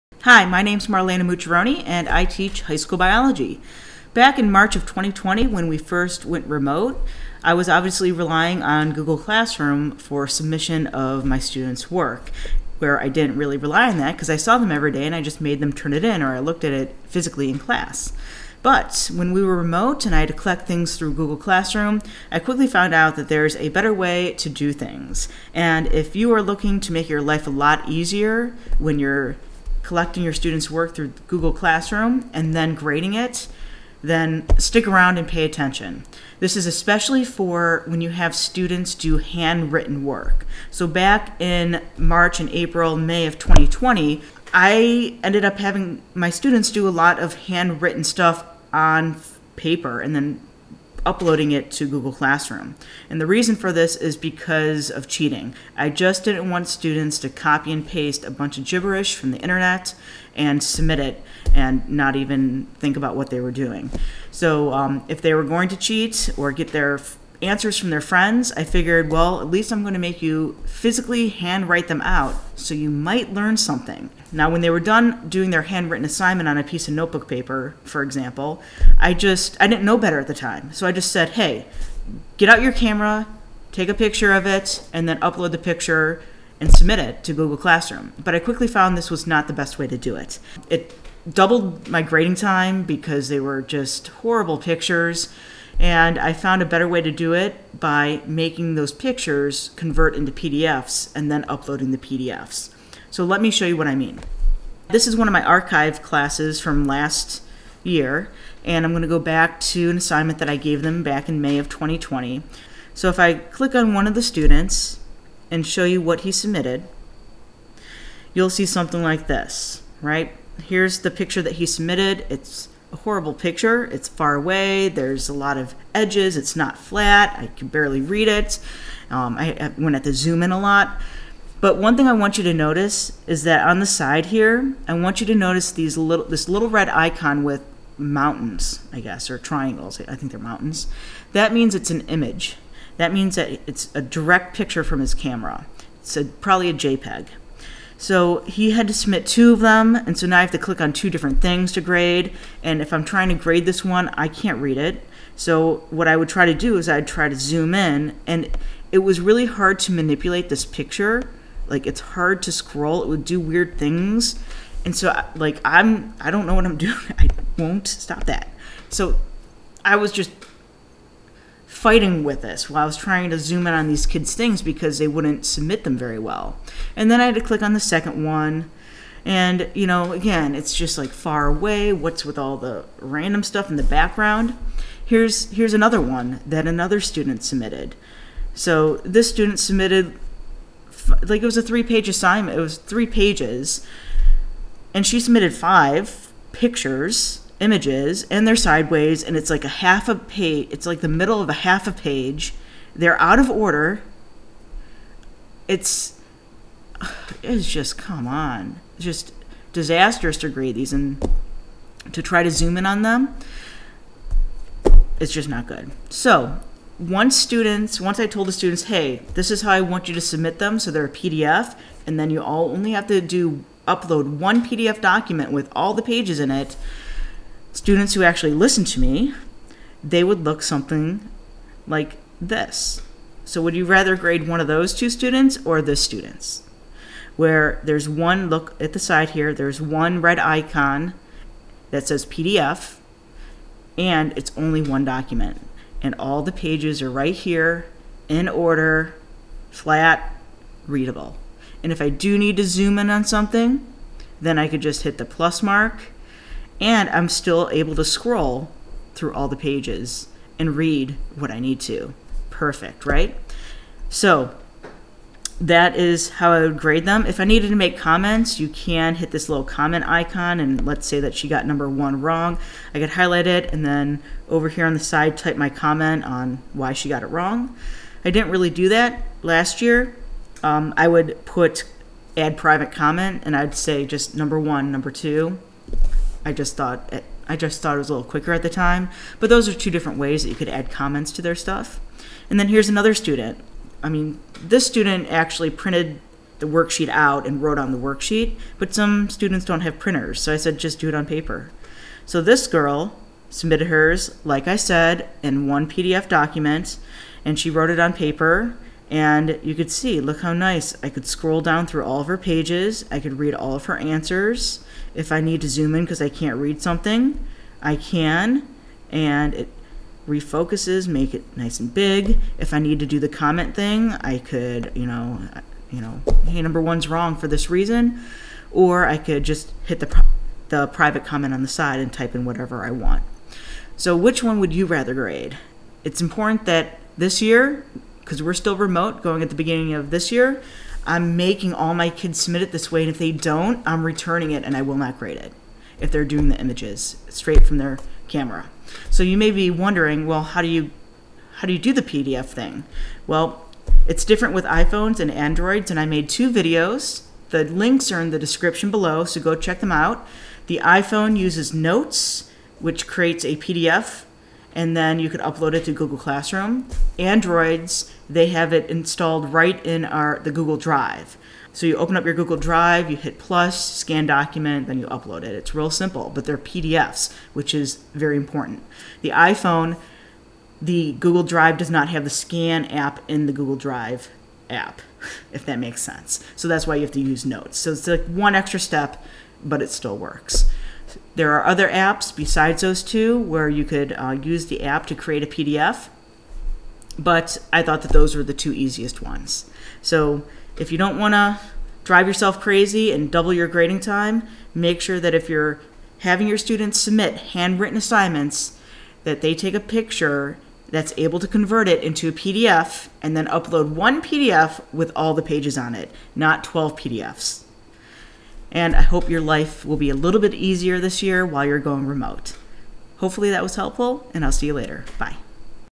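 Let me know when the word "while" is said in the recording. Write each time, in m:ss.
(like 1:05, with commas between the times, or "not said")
2:52, 7:01.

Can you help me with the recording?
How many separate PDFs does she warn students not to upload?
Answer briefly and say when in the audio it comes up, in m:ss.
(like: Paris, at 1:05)
12, at 6:56.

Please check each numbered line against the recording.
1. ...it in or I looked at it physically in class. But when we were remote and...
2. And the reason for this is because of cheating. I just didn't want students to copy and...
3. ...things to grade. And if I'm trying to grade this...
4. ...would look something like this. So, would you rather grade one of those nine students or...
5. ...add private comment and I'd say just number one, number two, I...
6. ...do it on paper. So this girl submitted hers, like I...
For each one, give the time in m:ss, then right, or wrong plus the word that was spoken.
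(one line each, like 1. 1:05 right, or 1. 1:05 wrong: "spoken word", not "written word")
1. 0:15 right
2. 0:53 right
3. 2:31 right
4. 3:50 wrong: "two", not "nine"
5. 4:42 right
6. 5:00 right.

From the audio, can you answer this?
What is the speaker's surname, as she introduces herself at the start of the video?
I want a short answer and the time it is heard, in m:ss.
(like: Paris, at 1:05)
Mucciarone, at 0:01.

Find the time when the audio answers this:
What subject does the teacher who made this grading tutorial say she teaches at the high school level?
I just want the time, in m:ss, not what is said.
0:02.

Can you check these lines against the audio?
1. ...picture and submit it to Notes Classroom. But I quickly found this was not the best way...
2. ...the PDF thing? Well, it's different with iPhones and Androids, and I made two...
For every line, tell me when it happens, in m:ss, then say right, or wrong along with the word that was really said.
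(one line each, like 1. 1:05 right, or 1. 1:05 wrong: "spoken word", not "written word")
1. 1:25 wrong: "Google", not "Notes"
2. 5:51 right.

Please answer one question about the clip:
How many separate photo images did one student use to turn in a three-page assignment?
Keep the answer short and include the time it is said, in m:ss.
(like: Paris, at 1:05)
5, at 3:15.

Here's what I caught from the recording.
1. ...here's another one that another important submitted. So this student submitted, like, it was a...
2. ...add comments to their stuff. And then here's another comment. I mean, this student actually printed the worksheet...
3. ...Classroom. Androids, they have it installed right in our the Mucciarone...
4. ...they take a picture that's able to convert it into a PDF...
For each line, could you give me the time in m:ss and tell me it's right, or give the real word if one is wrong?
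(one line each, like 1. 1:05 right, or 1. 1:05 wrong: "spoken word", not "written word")
1. 3:05 wrong: "student", not "important"
2. 4:50 wrong: "student", not "comment"
3. 6:06 wrong: "Google", not "Mucciarone"
4. 6:49 right.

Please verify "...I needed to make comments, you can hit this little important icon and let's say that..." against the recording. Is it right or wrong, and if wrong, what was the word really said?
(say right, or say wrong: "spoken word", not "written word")
wrong: "comment", not "important".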